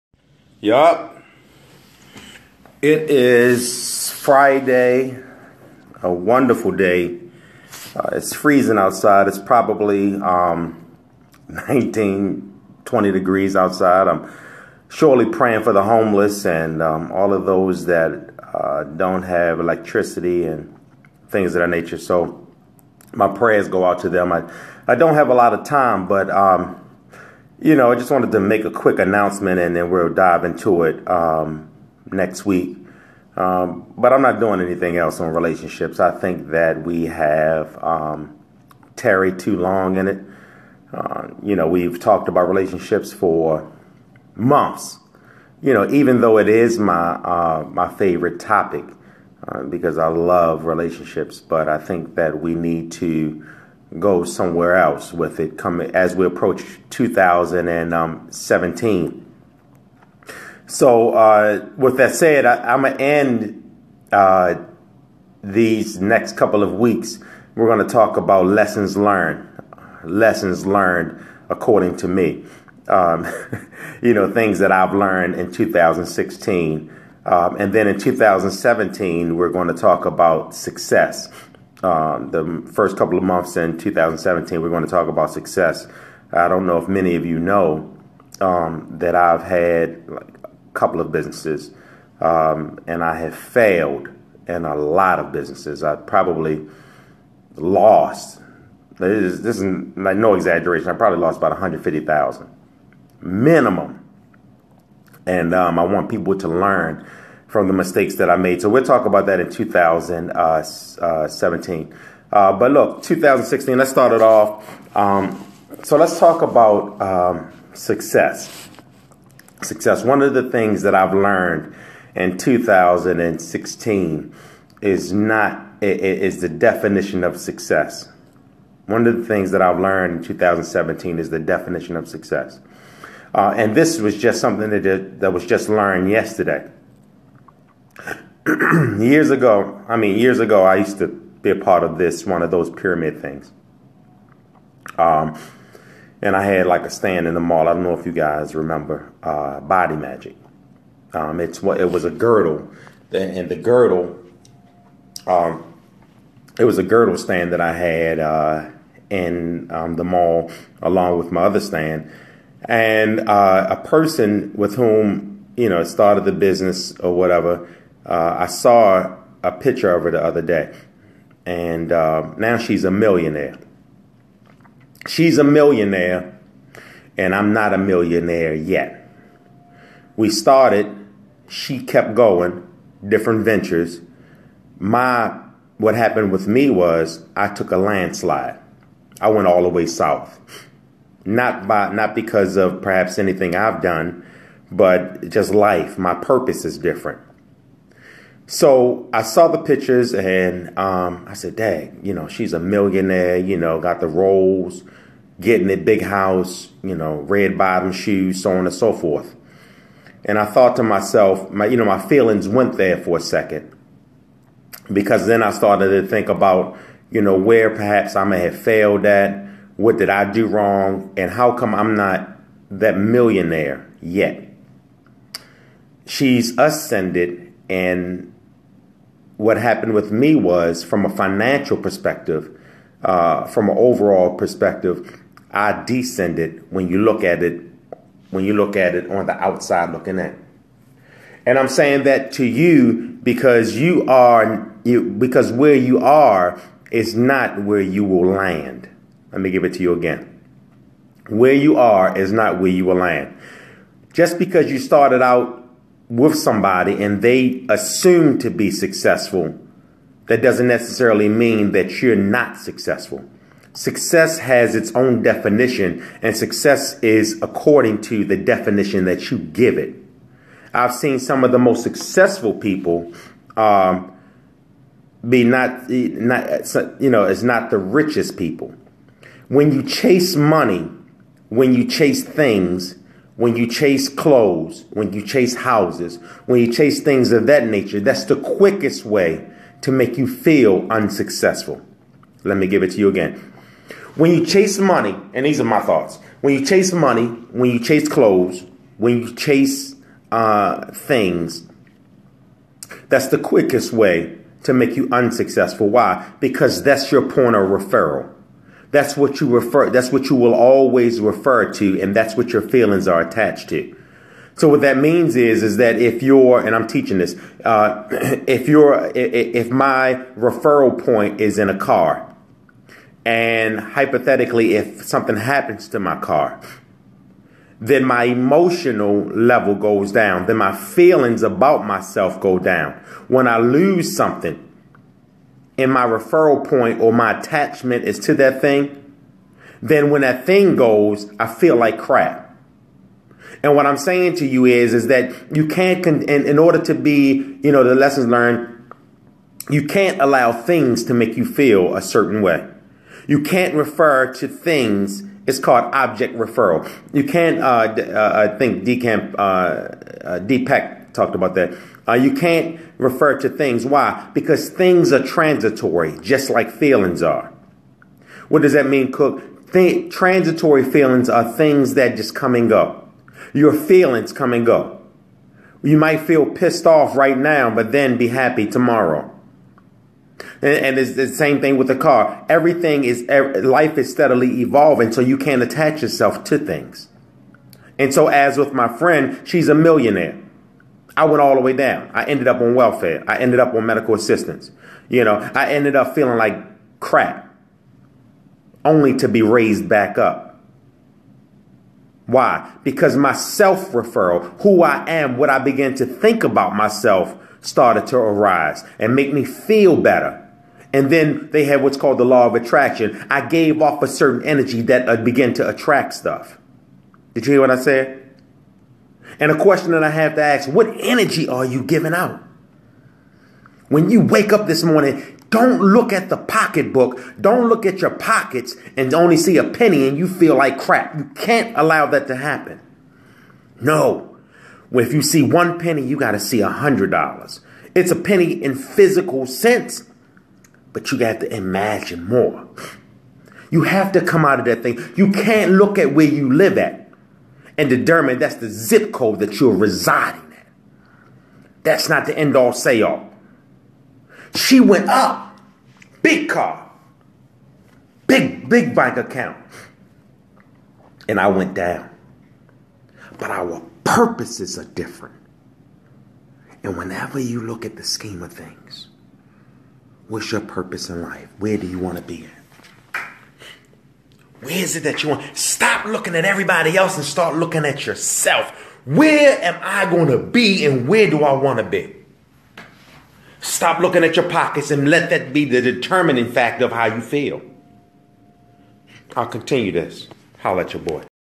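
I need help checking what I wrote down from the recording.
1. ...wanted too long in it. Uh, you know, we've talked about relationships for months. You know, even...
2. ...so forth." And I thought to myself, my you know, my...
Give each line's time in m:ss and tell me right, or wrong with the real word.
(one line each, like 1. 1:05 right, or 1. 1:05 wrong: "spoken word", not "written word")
1. 0:38 wrong: "tarried", not "wanted"
2. 3:28 right.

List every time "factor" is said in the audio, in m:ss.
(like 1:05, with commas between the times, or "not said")
8:06.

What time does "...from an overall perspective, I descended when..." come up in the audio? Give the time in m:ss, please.
3:53.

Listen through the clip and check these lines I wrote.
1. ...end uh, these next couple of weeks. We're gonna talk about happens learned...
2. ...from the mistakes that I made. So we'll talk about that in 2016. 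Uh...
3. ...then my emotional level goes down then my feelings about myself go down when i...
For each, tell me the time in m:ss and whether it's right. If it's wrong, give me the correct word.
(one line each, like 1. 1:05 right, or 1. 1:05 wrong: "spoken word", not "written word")
1. 1:02 wrong: "lessons", not "happens"
2. 1:47 wrong: "2017", not "2016"
3. 5:27 right.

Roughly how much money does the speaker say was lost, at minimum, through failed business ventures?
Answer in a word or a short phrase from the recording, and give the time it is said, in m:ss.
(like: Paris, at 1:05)
150,000, at 1:41.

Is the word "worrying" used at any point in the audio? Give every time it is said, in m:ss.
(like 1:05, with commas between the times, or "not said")
not said.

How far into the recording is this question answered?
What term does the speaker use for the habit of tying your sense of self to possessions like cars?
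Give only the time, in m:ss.
5:55.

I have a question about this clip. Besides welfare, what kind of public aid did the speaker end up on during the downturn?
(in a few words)
medical assistance.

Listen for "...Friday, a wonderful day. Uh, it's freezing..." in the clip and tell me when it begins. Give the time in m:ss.
0:04.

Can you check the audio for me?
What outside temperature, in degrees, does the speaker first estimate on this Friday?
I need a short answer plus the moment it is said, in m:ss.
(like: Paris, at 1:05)
20, at 0:12.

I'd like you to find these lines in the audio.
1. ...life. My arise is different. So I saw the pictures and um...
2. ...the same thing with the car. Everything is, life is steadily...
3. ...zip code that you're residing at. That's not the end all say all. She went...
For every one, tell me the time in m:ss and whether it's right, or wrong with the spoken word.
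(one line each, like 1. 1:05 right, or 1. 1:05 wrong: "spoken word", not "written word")
1. 3:15 wrong: "purpose", not "arise"
2. 6:21 right
3. 7:28 right.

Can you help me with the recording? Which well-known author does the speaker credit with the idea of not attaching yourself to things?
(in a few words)
Deepak.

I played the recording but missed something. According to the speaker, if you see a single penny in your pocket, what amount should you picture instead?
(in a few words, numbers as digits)
$100.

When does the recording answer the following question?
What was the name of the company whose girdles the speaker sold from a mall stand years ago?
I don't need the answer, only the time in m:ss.
2:29.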